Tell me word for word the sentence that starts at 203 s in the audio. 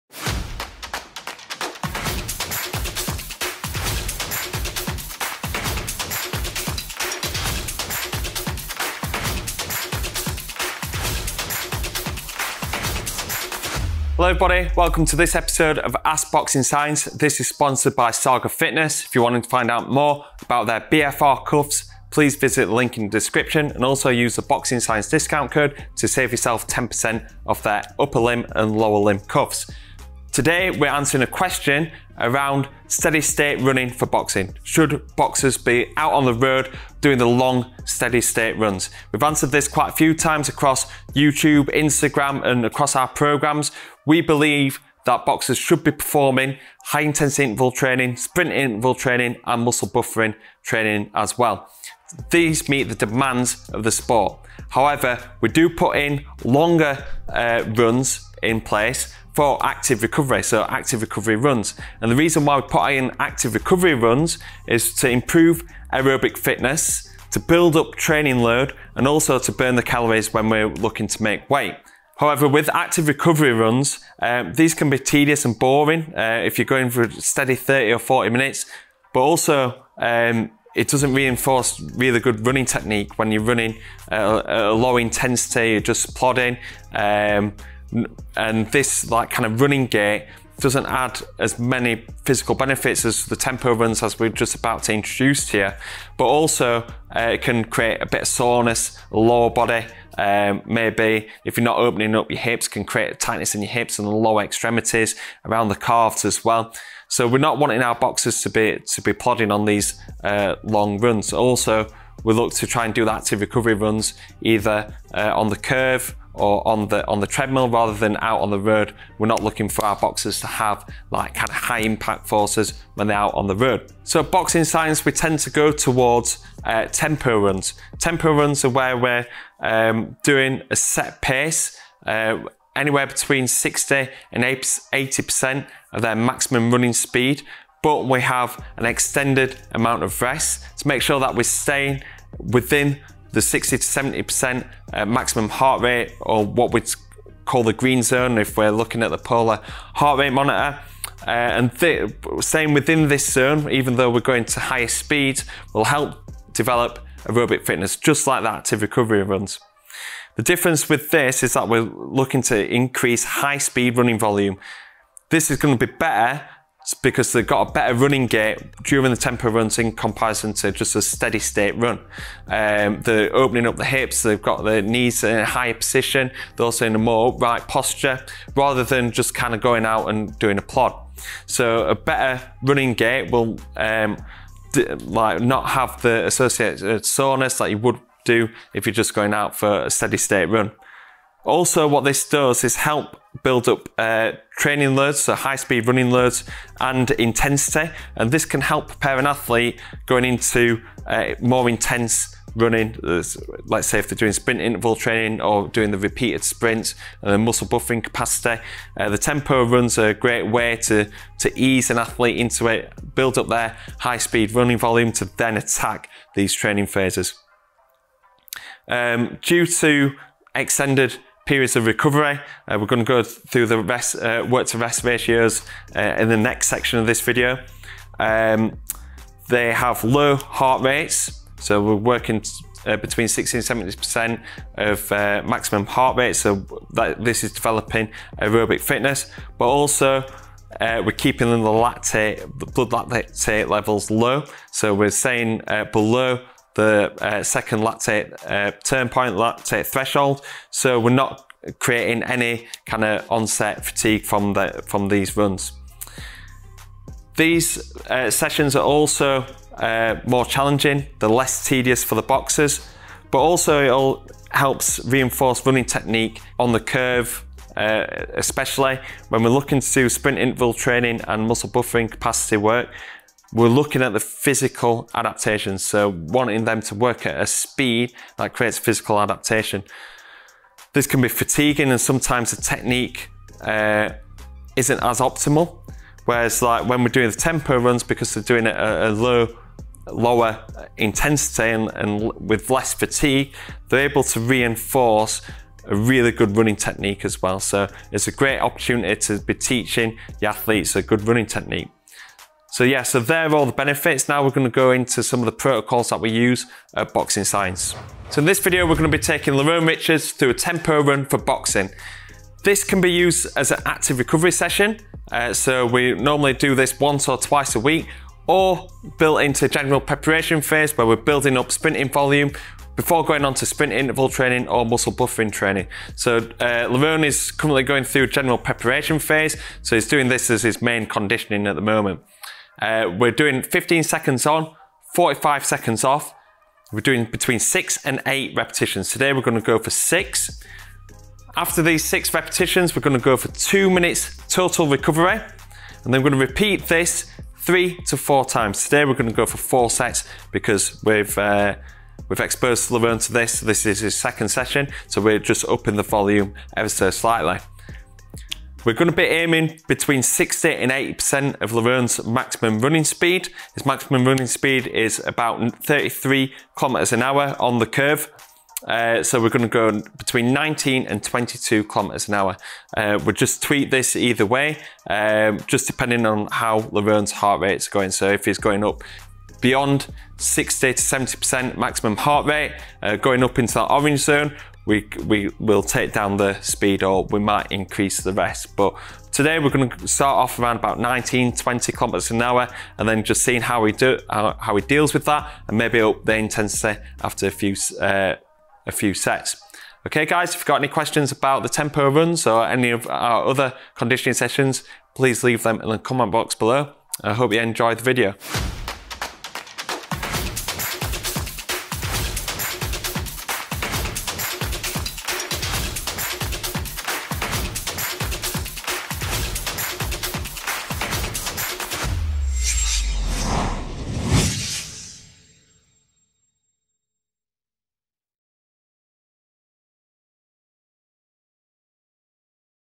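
Let's say if they're doing sprint interval training or doing the repeated sprints and the muscle buffering capacity.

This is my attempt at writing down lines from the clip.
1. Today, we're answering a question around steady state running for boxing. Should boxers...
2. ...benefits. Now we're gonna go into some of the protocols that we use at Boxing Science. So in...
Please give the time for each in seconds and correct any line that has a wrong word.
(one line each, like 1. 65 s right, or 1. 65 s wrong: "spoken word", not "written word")
1. 30 s right
2. 303 s right.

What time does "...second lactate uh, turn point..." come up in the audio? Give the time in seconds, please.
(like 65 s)
247 s.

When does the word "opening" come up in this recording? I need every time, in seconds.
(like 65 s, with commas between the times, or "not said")
101 s, 173 s.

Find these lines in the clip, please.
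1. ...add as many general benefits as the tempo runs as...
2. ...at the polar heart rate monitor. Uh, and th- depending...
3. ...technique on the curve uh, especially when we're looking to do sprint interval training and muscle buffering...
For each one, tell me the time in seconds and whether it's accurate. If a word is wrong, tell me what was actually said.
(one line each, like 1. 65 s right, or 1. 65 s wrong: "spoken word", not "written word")
1. 90 s wrong: "physical", not "general"
2. 149 s wrong: "staying", not "depending"
3. 265 s right.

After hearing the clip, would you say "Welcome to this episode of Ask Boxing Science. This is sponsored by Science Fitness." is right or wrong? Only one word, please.
wrong.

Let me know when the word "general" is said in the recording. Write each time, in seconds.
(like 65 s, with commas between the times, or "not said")
319 s, 328 s.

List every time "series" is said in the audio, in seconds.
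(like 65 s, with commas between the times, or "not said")
not said.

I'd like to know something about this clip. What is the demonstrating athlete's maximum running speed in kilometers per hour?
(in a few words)
33.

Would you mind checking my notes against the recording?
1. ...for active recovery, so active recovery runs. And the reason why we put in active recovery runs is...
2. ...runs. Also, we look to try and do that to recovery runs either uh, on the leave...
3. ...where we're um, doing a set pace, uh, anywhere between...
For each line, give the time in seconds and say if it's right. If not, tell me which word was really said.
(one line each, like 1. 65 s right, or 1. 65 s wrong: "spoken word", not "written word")
1. 59 s right
2. 110 s wrong: "curve", not "leave"
3. 128 s right.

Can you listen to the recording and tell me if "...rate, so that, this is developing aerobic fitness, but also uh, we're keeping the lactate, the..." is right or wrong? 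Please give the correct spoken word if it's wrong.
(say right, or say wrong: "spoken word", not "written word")
right.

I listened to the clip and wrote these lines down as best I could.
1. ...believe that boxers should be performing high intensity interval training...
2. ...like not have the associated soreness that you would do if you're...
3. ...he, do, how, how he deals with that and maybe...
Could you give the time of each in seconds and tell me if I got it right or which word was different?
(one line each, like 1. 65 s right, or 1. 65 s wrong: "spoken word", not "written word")
1. 44 s right
2. 185 s right
3. 393 s right.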